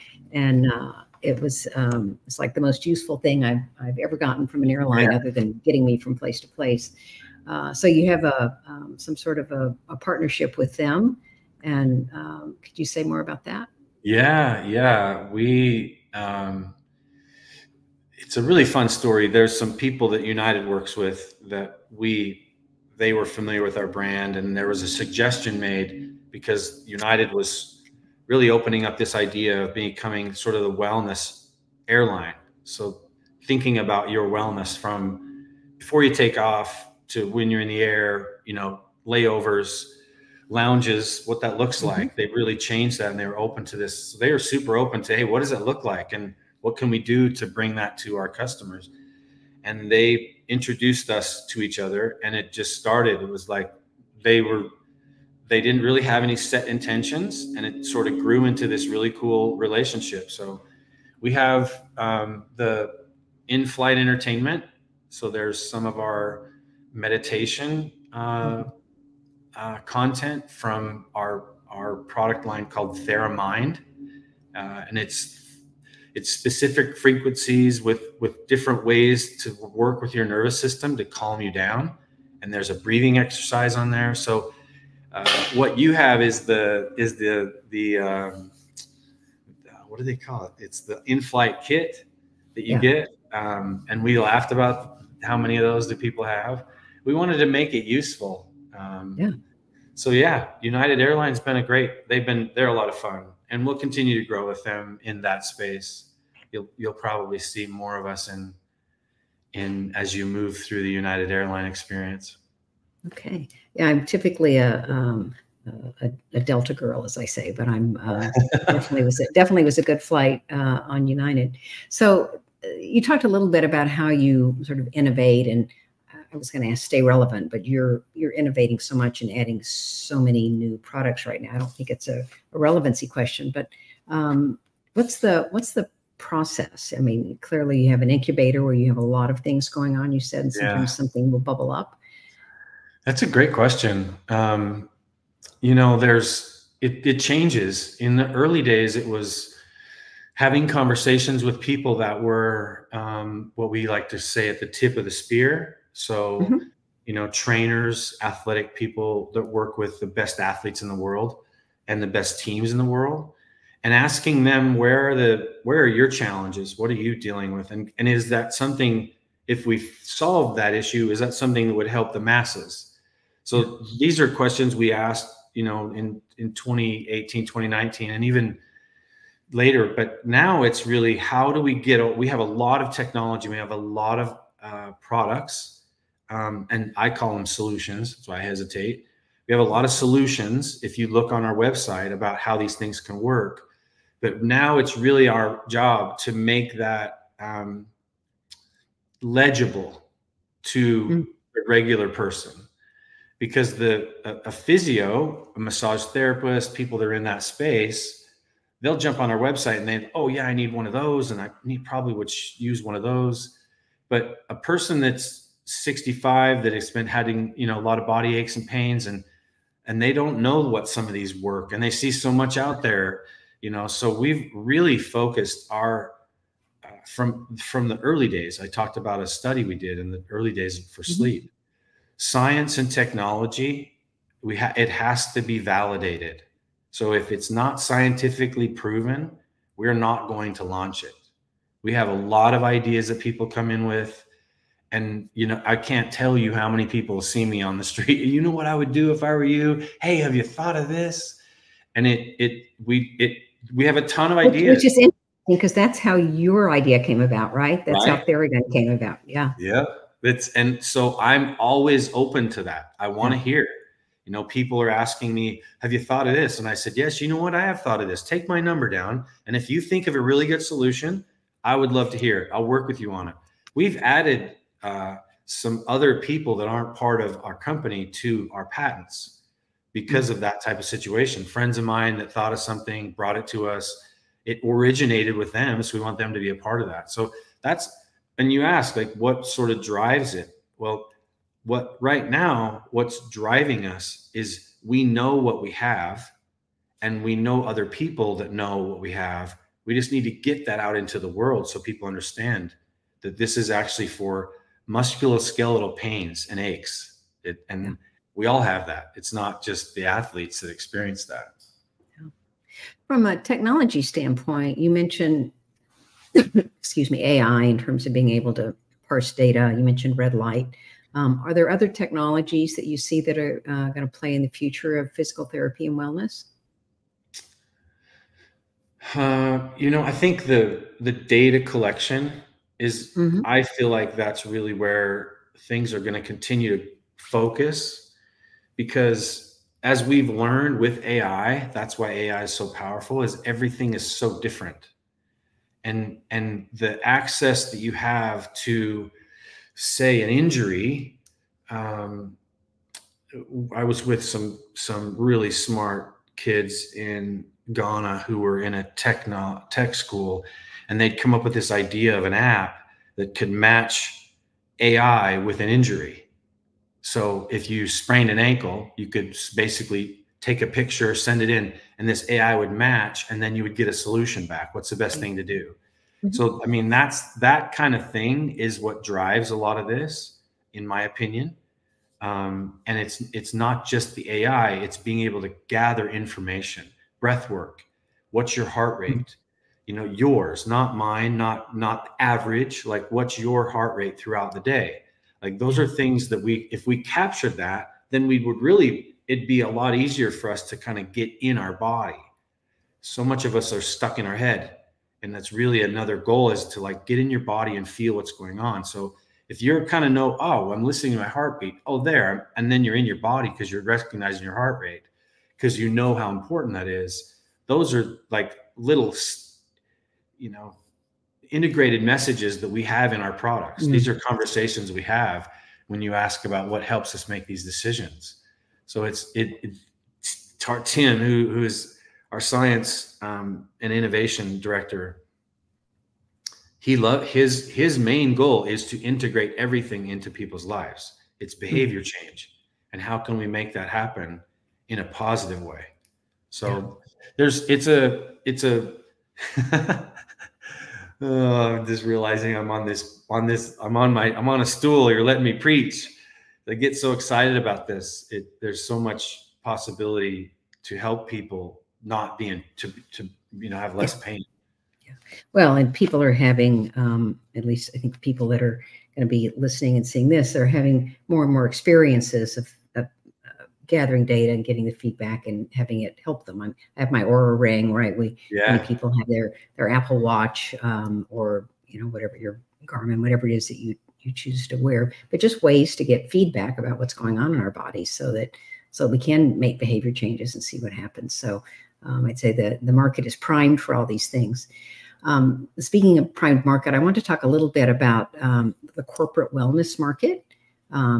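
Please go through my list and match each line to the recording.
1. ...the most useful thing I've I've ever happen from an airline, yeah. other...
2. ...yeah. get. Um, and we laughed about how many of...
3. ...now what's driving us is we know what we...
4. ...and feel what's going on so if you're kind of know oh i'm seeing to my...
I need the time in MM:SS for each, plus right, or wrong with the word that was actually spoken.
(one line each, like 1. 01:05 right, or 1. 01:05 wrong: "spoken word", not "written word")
1. 00:02 wrong: "gotten", not "happen"
2. 01:32 right
3. 04:52 right
4. 06:47 wrong: "listening", not "seeing".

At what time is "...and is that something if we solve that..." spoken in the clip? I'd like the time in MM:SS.
02:47.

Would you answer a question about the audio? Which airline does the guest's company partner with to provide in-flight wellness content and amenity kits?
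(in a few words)
United Airlines.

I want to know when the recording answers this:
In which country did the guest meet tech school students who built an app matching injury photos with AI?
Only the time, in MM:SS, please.
05:57.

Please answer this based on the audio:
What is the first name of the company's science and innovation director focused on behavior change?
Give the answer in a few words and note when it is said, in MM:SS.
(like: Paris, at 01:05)
Tim, at 07:10.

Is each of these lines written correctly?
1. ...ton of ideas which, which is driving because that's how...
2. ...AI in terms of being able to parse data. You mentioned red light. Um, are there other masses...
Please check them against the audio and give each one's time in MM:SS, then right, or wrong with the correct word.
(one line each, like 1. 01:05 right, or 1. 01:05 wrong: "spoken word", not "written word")
1. 04:14 wrong: "interesting", not "driving"
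2. 05:17 wrong: "technologies", not "masses".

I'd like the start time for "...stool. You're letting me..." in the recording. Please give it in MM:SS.
07:34.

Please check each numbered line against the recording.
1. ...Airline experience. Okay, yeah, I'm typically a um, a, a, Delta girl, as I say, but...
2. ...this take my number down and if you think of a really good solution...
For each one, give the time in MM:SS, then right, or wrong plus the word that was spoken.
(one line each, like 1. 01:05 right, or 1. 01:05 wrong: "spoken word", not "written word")
1. 01:51 right
2. 04:28 right.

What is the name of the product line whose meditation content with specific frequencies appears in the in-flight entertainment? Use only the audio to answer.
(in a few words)
TheraMind.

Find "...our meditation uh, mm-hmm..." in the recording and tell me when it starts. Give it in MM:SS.
01:05.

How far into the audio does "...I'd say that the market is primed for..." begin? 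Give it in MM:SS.
08:12.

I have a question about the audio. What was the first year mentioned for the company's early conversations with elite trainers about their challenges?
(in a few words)
2018.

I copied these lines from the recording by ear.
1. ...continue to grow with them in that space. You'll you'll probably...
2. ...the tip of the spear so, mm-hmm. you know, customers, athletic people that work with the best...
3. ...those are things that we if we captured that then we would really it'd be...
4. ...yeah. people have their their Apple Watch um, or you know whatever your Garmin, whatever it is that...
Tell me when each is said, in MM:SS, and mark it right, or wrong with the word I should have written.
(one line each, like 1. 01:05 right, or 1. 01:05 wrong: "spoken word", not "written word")
1. 01:43 right
2. 02:34 wrong: "trainers", not "customers"
3. 06:35 right
4. 07:58 right.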